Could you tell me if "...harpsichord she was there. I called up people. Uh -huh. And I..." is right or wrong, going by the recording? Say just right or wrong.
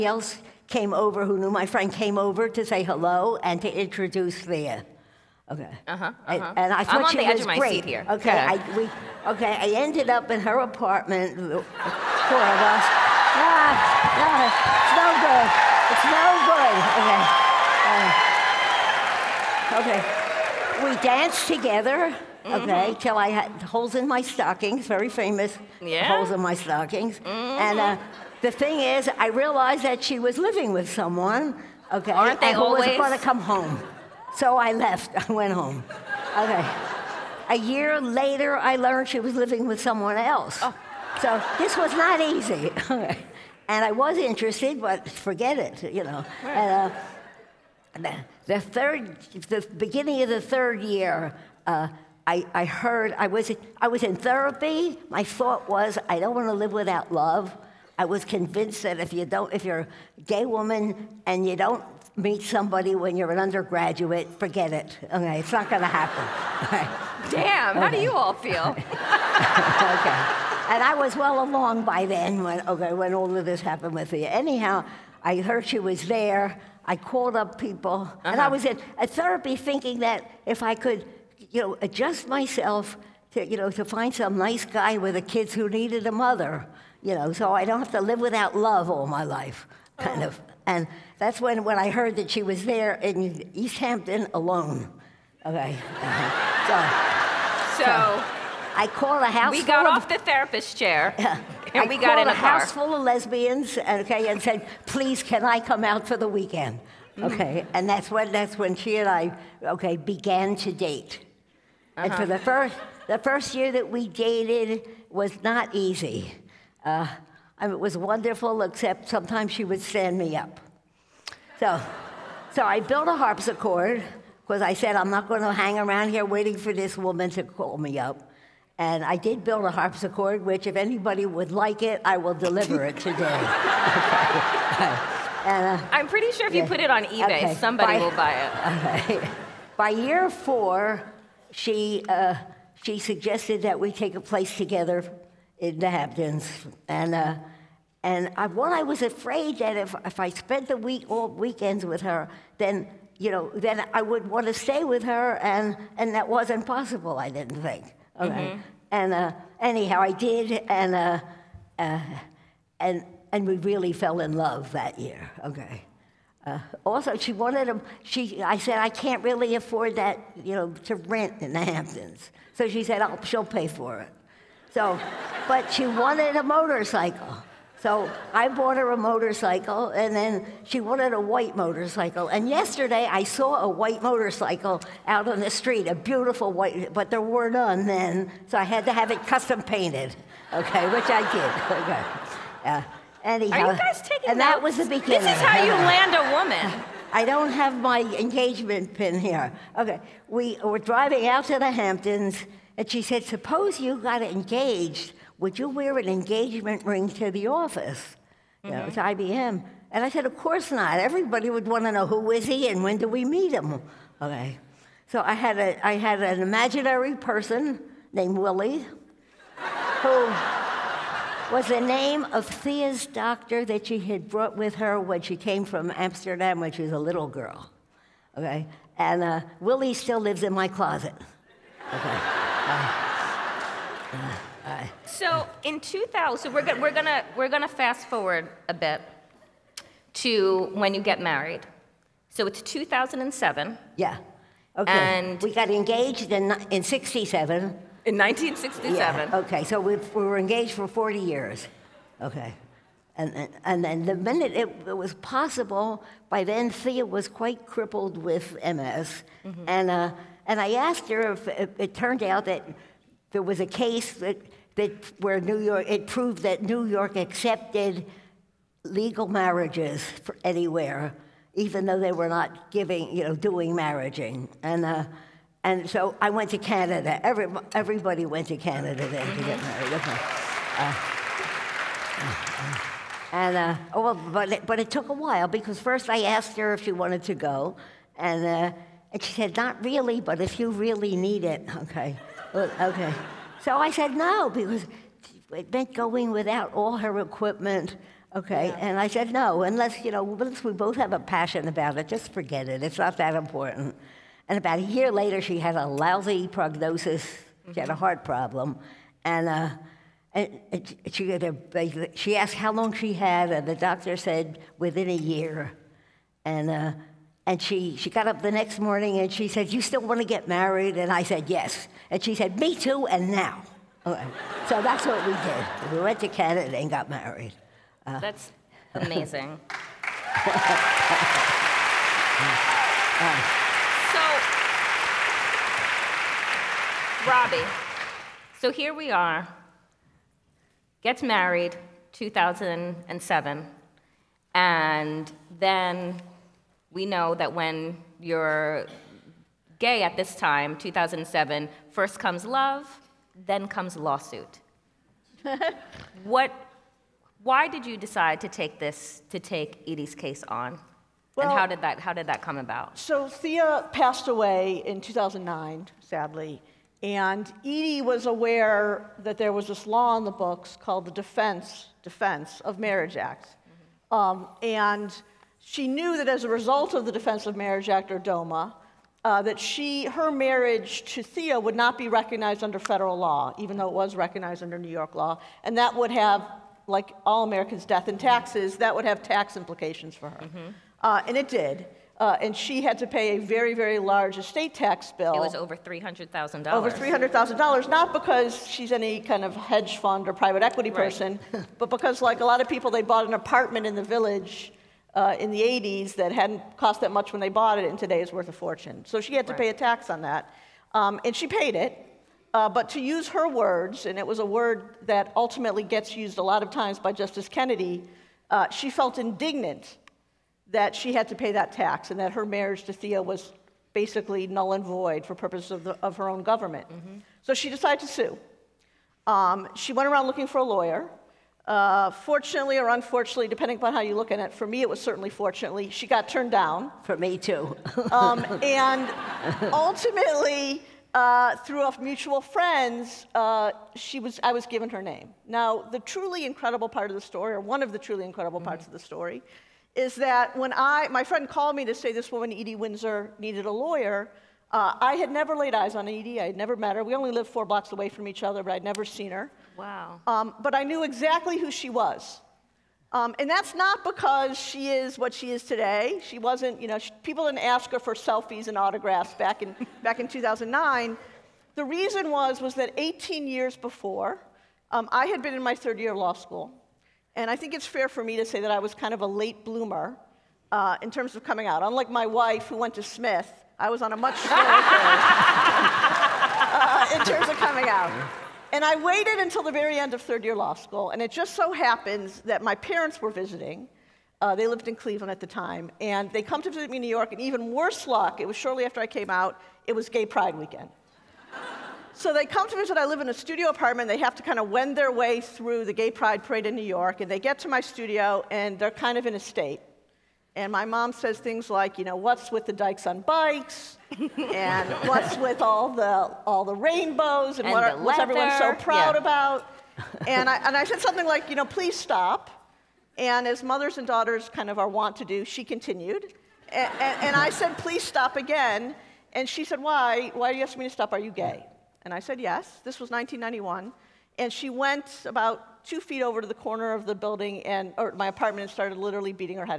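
wrong.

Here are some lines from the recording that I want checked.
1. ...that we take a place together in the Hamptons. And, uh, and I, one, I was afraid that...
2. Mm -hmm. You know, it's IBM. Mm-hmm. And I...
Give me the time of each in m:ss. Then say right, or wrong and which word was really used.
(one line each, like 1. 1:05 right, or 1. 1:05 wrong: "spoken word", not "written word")
1. 2:23 right
2. 3:28 right.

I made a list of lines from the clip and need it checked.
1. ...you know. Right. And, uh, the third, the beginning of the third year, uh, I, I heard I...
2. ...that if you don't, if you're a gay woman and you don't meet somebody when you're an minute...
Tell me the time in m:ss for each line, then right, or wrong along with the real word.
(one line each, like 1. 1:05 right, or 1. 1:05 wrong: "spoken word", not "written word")
1. 0:45 right
2. 0:58 wrong: "undergraduate", not "minute".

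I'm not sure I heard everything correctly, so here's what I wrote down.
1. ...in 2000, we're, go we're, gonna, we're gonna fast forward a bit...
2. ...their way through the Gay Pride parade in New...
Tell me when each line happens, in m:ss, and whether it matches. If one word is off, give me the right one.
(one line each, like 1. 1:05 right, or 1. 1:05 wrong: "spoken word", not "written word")
1. 3:55 right
2. 8:24 right.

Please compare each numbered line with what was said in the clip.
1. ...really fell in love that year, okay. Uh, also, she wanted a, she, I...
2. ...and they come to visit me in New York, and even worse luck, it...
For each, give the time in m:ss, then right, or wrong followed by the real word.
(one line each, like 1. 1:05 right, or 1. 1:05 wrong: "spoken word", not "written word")
1. 2:43 right
2. 8:16 right.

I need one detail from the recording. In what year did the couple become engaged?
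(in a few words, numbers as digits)
1967.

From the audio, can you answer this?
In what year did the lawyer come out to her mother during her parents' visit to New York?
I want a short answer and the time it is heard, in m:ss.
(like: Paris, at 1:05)
1991, at 8:53.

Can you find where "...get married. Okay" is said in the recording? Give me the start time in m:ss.
4:39.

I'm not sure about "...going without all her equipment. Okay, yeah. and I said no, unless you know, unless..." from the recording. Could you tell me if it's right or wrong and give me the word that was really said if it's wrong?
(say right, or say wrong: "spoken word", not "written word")
right.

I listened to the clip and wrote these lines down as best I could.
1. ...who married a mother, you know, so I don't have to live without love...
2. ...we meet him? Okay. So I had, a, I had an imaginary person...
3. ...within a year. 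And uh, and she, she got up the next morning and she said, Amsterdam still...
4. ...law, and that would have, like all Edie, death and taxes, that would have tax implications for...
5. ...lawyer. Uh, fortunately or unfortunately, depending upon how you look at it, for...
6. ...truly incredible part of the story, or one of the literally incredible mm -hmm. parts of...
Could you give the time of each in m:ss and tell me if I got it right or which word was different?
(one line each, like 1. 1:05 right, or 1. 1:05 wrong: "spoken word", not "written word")
1. 1:25 wrong: "needed", not "married"
2. 3:33 right
3. 5:14 wrong: "You", not "Amsterdam"
4. 6:25 wrong: "Americans", not "Edie"
5. 7:10 right
6. 7:26 wrong: "truly", not "literally".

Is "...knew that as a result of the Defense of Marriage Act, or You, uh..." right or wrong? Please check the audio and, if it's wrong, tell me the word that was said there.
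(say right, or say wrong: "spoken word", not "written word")
wrong: "DOMA", not "You".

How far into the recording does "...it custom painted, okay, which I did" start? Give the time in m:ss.
3:09.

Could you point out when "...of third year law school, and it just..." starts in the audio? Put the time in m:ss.
8:10.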